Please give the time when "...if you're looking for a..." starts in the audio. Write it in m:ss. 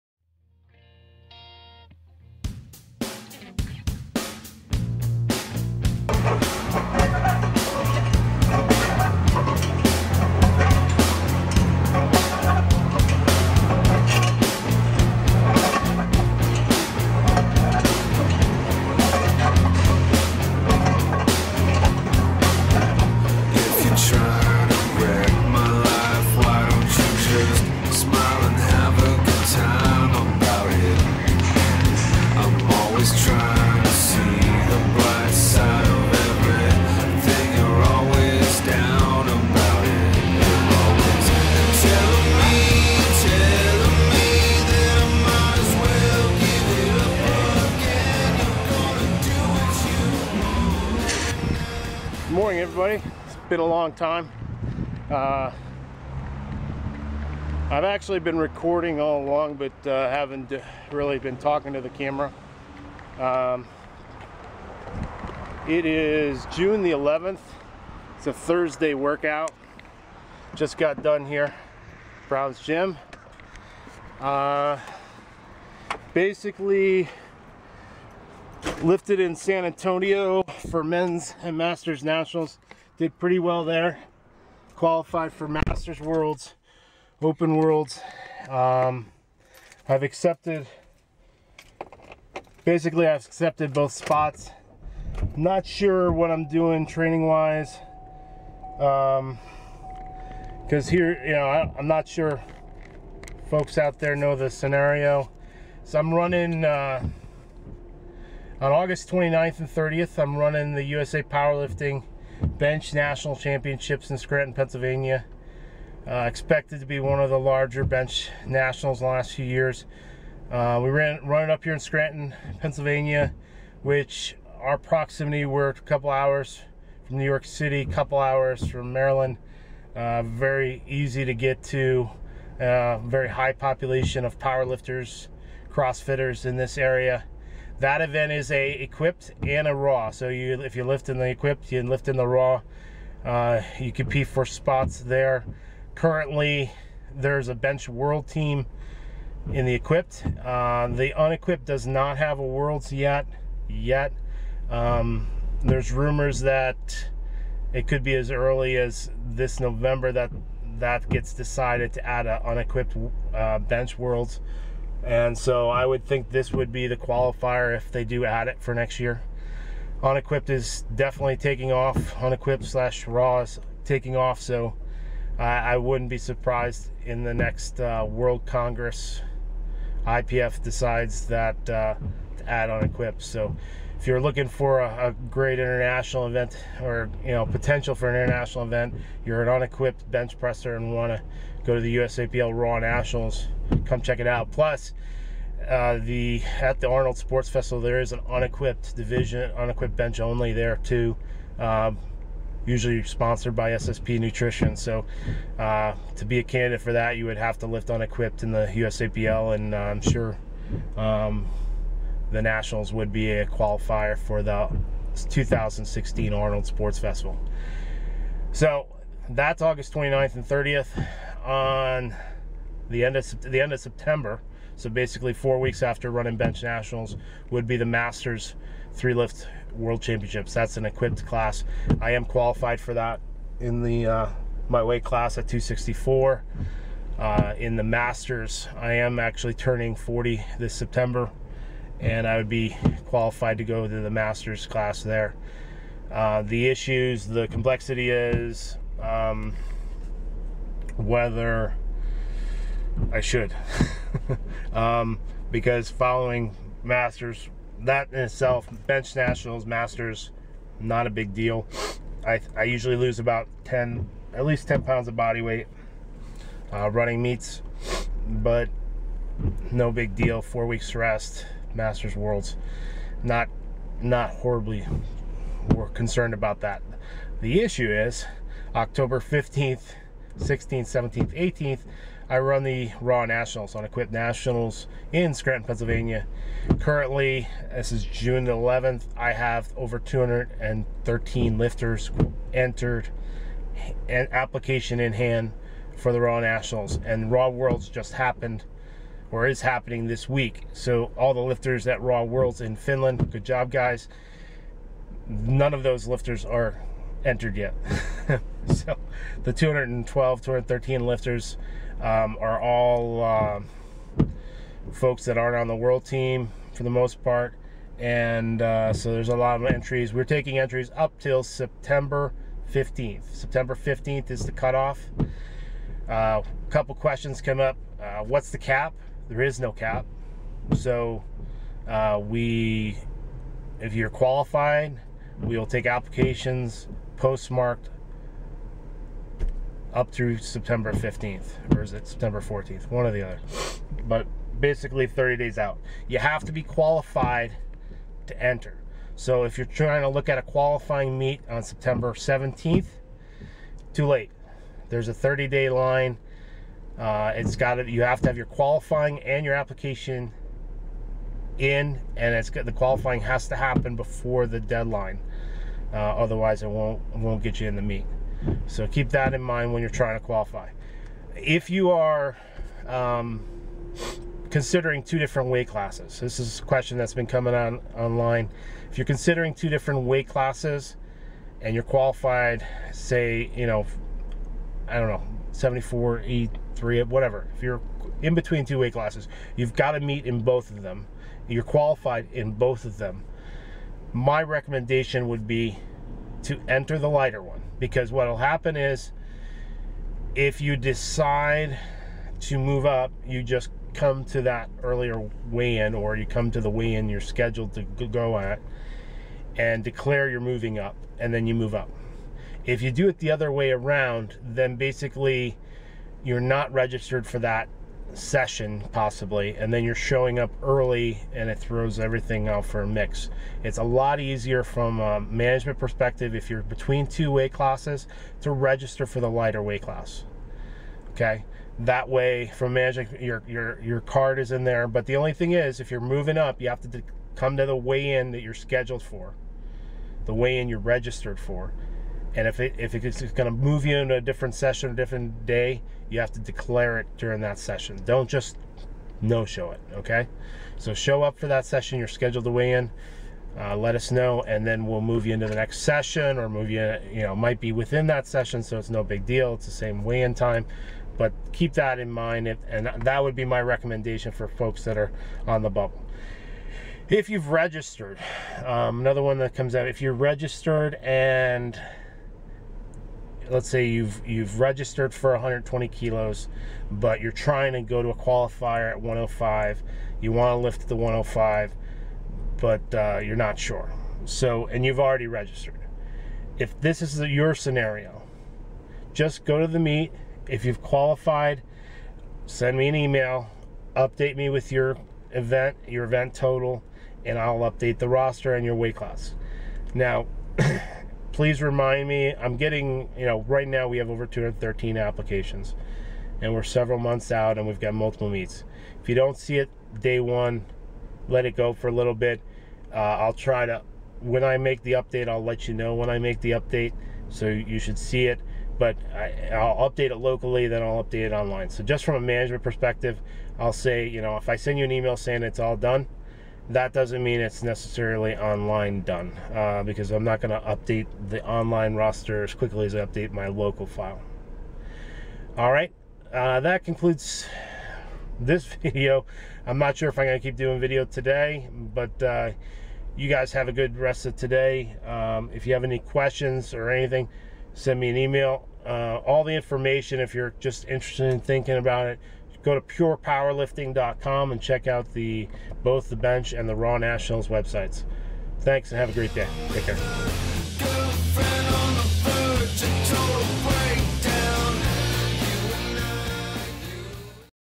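3:03.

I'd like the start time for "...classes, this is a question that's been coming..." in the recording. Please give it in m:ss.
6:15.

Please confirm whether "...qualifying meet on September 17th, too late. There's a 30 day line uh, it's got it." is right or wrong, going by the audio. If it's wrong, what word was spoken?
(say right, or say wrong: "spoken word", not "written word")
right.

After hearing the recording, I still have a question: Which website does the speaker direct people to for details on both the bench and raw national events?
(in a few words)
purepowerlifting.com.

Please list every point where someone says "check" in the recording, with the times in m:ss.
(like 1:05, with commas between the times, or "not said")
3:14, 9:14.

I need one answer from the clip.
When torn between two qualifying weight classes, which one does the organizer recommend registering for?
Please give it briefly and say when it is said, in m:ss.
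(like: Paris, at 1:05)
the lighter one, at 6:37.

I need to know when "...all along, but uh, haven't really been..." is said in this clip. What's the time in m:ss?
0:59.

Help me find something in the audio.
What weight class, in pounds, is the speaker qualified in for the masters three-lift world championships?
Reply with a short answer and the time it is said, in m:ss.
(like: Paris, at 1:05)
264, at 3:55.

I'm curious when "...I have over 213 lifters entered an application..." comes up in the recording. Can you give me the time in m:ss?
4:49.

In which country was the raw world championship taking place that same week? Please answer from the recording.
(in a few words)
Finland.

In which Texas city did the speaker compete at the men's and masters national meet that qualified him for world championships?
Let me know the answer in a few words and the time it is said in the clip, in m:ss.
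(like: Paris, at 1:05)
San Antonio, at 1:19.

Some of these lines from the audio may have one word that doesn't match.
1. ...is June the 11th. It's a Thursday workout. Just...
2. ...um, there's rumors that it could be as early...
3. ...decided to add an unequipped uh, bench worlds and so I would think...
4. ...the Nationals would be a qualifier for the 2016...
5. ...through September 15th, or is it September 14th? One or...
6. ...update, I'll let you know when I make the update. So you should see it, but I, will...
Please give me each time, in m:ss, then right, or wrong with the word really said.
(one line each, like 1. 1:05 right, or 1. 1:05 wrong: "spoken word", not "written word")
1. 1:05 right
2. 2:34 right
3. 2:41 right
4. 3:32 right
5. 5:40 right
6. 8:34 right.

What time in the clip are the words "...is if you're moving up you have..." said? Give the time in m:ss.
7:15.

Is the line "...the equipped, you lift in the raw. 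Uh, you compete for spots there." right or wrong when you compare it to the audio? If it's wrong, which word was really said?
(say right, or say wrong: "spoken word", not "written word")
right.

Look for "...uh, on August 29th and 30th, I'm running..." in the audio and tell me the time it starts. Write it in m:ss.
1:46.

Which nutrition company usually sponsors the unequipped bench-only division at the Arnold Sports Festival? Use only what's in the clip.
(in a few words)
SSP Nutrition.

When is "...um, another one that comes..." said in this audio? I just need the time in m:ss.
7:48.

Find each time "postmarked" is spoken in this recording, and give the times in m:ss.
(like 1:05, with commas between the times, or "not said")
5:37.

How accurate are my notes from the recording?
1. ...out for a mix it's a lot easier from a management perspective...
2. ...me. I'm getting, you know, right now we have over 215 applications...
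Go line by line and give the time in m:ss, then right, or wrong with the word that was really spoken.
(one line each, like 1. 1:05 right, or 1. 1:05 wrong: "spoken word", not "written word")
1. 7:02 right
2. 8:22 wrong: "213", not "215".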